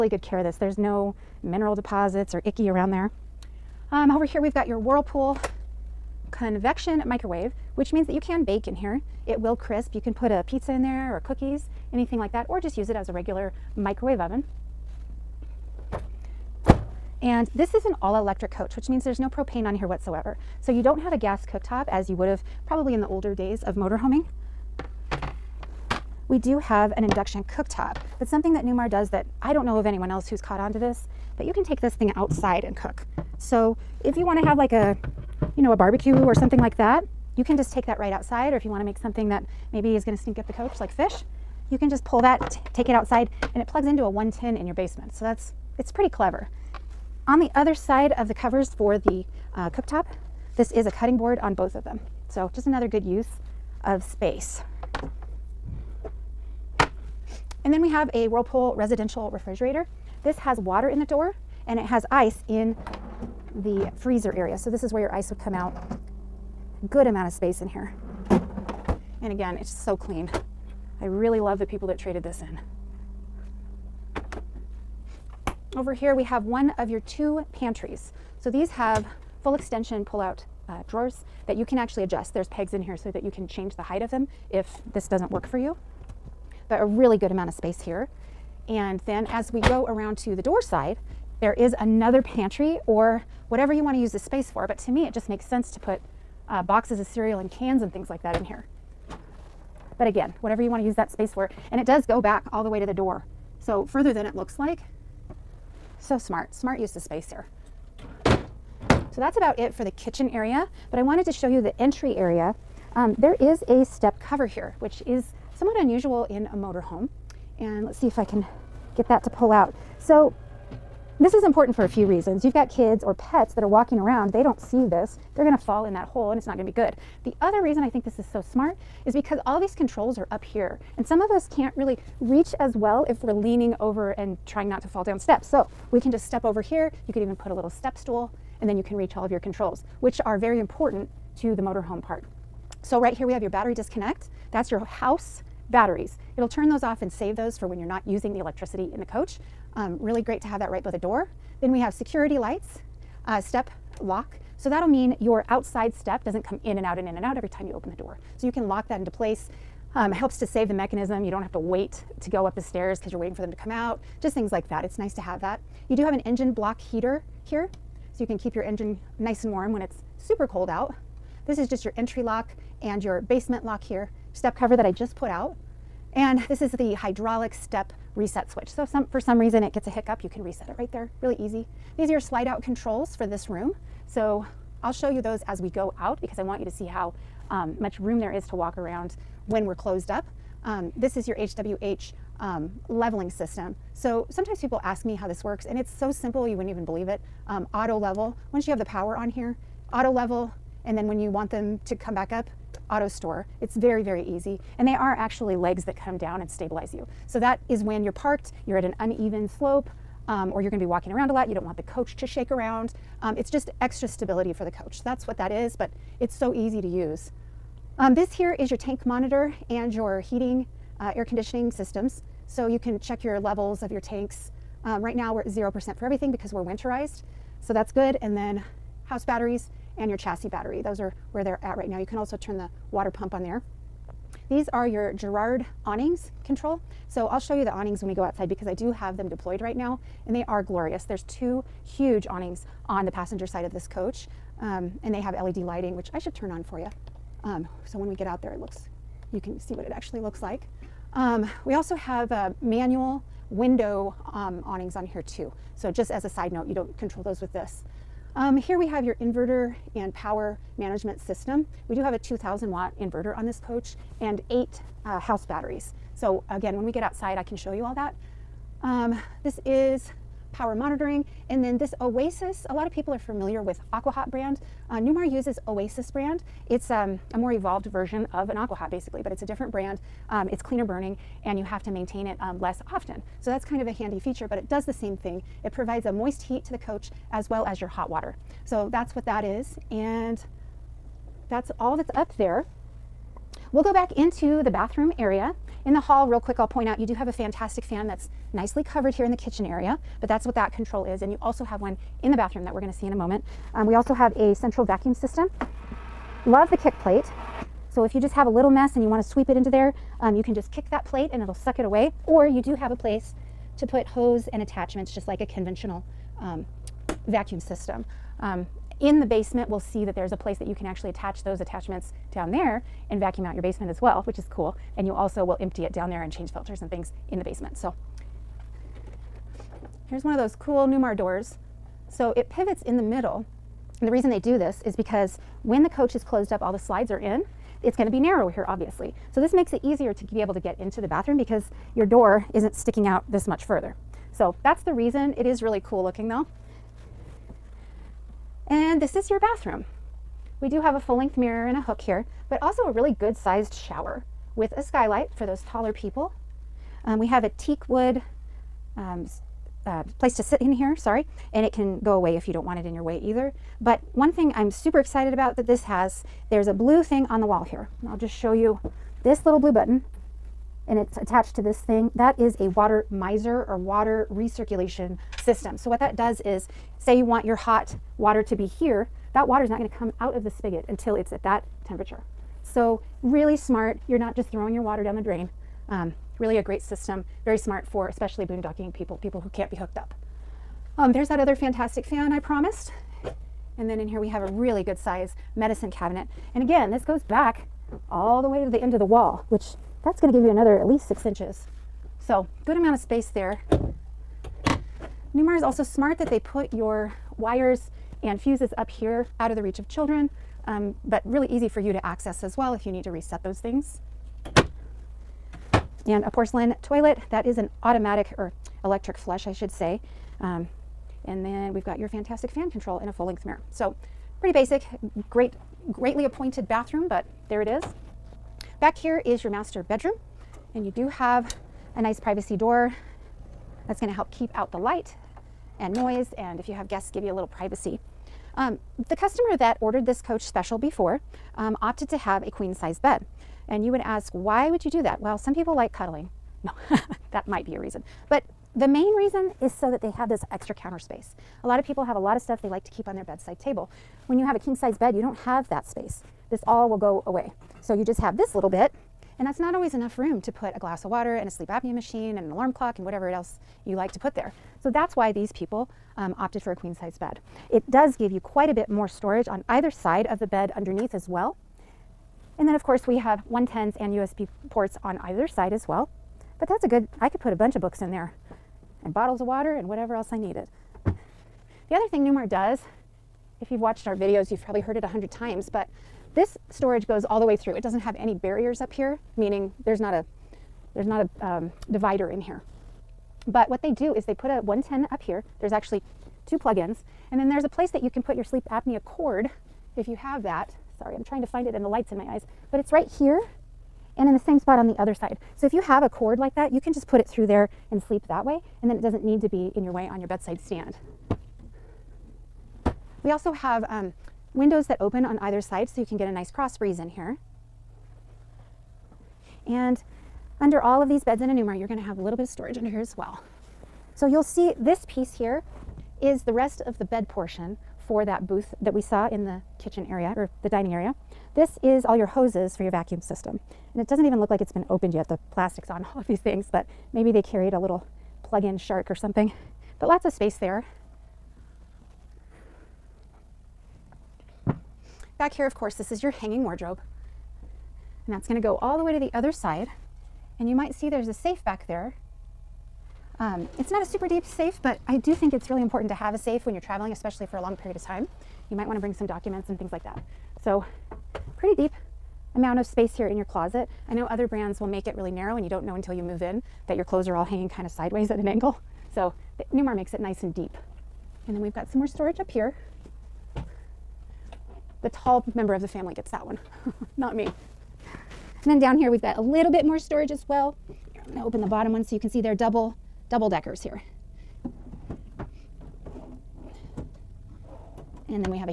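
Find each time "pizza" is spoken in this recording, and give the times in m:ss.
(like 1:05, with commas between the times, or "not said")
0:10.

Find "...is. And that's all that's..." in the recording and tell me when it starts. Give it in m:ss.
4:49.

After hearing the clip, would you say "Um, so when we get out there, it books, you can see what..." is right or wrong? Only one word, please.
wrong.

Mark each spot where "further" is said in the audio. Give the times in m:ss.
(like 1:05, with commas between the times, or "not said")
1:43, 5:43.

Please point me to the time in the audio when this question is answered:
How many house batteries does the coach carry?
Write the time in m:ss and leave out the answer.
4:24.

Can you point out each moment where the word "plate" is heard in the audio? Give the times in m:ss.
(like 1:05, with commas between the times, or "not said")
5:06, 5:11.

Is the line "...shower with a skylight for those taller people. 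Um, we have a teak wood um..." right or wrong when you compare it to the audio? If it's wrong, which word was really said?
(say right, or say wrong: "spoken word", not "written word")
right.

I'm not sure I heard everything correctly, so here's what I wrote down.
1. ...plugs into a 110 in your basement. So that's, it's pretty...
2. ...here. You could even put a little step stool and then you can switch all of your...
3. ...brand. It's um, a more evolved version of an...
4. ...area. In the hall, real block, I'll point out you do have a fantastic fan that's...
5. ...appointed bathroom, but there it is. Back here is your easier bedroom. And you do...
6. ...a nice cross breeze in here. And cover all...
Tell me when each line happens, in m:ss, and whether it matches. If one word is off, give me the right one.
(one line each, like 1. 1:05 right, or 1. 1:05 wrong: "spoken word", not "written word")
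1. 0:43 right
2. 2:16 wrong: "reach", not "switch"
3. 4:36 right
4. 4:55 wrong: "quick", not "block"
5. 7:06 wrong: "master", not "easier"
6. 8:36 wrong: "under", not "cover".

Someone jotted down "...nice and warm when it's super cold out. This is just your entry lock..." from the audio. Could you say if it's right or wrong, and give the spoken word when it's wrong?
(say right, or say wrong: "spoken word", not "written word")
right.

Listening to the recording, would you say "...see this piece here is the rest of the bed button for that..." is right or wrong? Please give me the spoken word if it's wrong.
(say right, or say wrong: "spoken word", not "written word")
wrong: "portion", not "button".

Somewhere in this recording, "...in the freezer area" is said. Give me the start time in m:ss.
1:02.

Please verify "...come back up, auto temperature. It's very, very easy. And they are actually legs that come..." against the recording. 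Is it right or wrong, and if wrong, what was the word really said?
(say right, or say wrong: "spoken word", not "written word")
wrong: "store", not "temperature".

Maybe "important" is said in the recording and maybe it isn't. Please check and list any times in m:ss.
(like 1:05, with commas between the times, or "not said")
2:01, 2:20, 9:15.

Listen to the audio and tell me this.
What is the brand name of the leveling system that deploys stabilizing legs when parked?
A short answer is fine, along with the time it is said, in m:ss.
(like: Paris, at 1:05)
HWH, at 3:11.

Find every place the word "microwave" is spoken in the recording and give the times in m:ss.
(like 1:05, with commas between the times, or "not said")
0:07, 0:13.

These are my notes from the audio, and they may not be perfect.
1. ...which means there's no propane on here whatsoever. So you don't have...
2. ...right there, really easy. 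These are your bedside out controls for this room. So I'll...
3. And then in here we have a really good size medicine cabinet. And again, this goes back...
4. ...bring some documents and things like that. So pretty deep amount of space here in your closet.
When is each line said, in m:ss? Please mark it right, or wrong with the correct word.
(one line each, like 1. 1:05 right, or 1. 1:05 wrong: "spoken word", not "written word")
1. 0:18 right
2. 3:00 wrong: "slide", not "bedside"
3. 6:33 right
4. 9:18 right.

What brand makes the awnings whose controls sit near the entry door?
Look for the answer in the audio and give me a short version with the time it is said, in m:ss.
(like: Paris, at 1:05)
Girard, at 3:55.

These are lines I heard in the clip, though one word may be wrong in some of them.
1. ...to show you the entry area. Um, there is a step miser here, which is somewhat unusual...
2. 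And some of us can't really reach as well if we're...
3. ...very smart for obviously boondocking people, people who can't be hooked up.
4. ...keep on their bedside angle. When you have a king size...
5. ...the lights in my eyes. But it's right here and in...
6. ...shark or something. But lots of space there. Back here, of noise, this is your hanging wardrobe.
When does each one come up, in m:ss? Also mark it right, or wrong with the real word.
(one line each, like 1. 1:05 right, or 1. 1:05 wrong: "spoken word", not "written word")
1. 1:51 wrong: "cover", not "miser"
2. 2:10 right
3. 6:27 wrong: "especially", not "obviously"
4. 7:32 wrong: "table", not "angle"
5. 8:21 right
6. 8:58 wrong: "course", not "noise".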